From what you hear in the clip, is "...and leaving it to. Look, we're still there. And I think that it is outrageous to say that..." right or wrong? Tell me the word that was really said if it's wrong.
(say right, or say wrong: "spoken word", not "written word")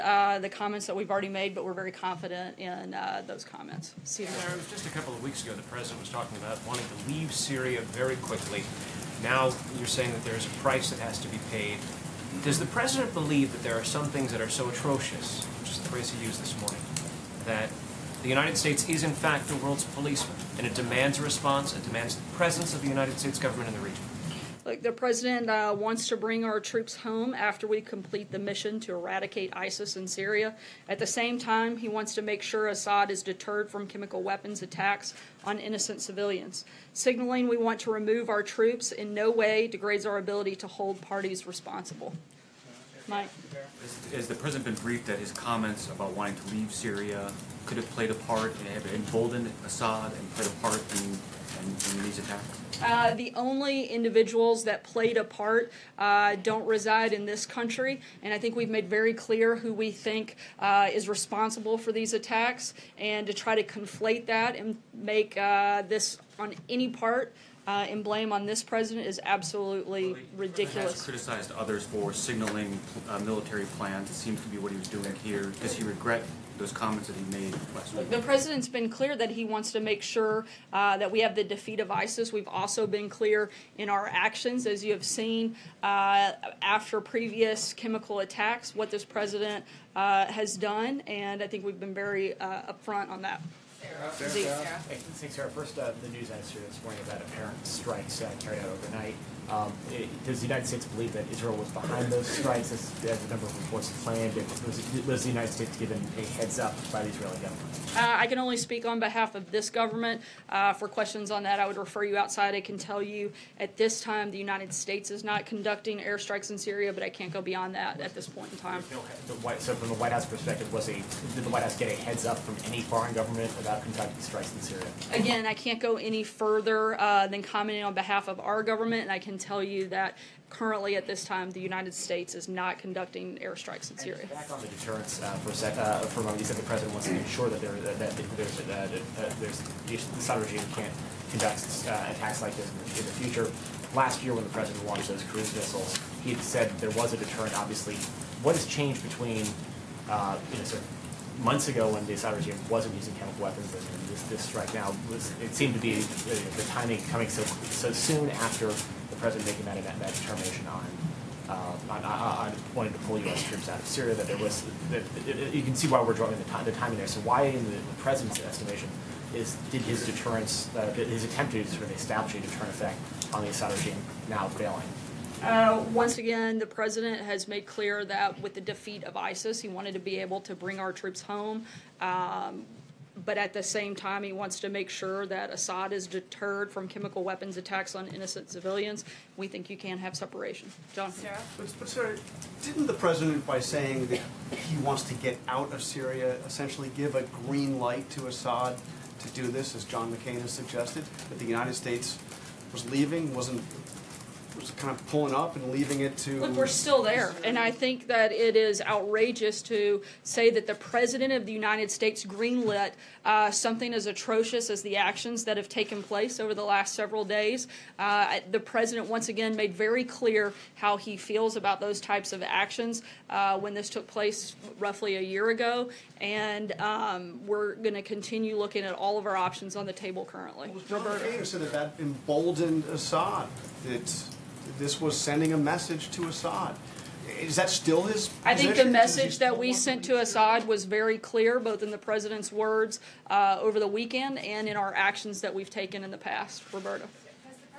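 right.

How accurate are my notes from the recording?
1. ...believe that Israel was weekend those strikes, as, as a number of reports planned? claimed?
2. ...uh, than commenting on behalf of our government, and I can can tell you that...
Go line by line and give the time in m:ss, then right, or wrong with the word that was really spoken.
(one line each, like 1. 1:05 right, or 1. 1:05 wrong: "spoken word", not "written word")
1. 1:40 wrong: "behind", not "weekend"
2. 2:06 right.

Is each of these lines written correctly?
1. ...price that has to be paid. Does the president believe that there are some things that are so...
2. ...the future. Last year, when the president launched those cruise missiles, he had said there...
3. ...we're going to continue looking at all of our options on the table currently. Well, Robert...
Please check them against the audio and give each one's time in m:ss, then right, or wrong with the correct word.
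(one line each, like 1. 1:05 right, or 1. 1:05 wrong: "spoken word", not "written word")
1. 0:10 right
2. 2:23 right
3. 3:47 right.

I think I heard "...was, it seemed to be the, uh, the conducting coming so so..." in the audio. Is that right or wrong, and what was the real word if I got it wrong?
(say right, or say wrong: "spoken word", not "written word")
wrong: "timing", not "conducting".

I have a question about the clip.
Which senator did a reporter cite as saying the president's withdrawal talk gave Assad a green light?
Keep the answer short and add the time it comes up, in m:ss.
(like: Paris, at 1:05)
John McCain, at 3:19.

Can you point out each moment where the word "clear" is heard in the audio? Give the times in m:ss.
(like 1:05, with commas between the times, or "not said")
0:59, 1:18, 1:23, 2:57, 3:40, 4:01.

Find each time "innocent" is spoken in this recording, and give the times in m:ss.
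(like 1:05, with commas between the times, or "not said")
0:35, 3:08.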